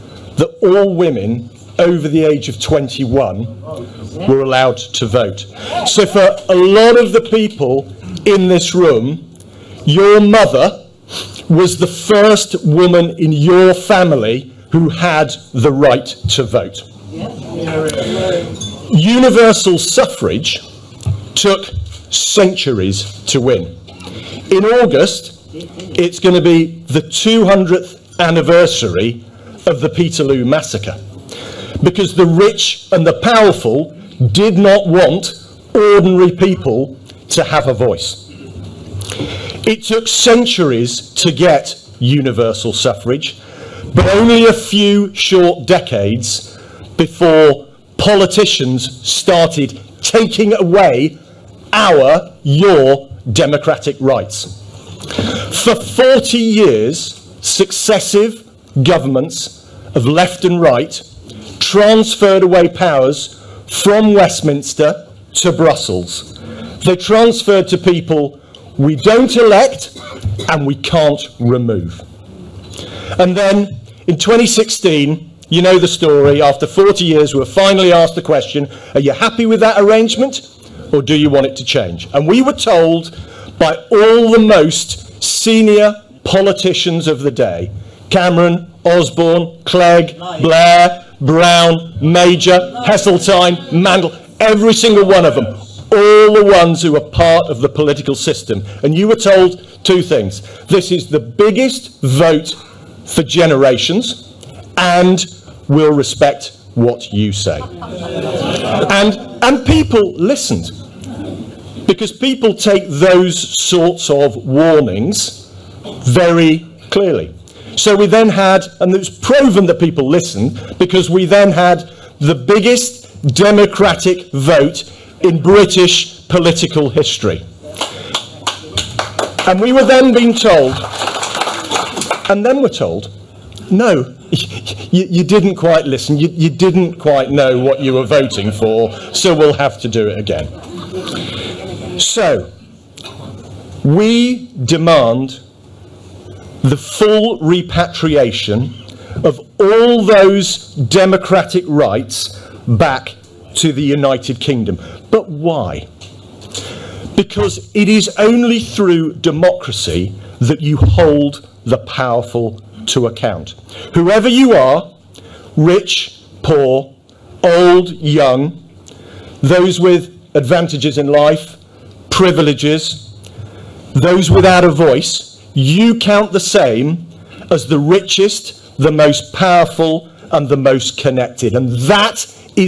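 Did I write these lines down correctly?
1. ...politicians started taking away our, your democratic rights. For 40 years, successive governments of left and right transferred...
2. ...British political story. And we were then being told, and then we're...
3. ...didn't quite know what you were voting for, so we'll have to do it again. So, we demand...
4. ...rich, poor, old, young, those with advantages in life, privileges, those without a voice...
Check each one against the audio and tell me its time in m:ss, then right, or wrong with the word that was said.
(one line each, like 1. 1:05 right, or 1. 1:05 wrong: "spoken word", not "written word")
1. 0:47 right
2. 2:05 wrong: "history", not "story"
3. 2:16 right
4. 2:45 right.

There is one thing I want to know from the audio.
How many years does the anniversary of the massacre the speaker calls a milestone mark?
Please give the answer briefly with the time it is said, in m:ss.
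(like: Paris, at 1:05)
200, at 0:27.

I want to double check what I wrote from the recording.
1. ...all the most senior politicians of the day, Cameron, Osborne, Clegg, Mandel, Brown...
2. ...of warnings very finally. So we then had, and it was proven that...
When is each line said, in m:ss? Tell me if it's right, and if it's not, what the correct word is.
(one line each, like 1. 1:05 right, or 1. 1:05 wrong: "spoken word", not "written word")
1. 1:23 wrong: "Blair", not "Mandel"
2. 1:54 wrong: "clearly", not "finally".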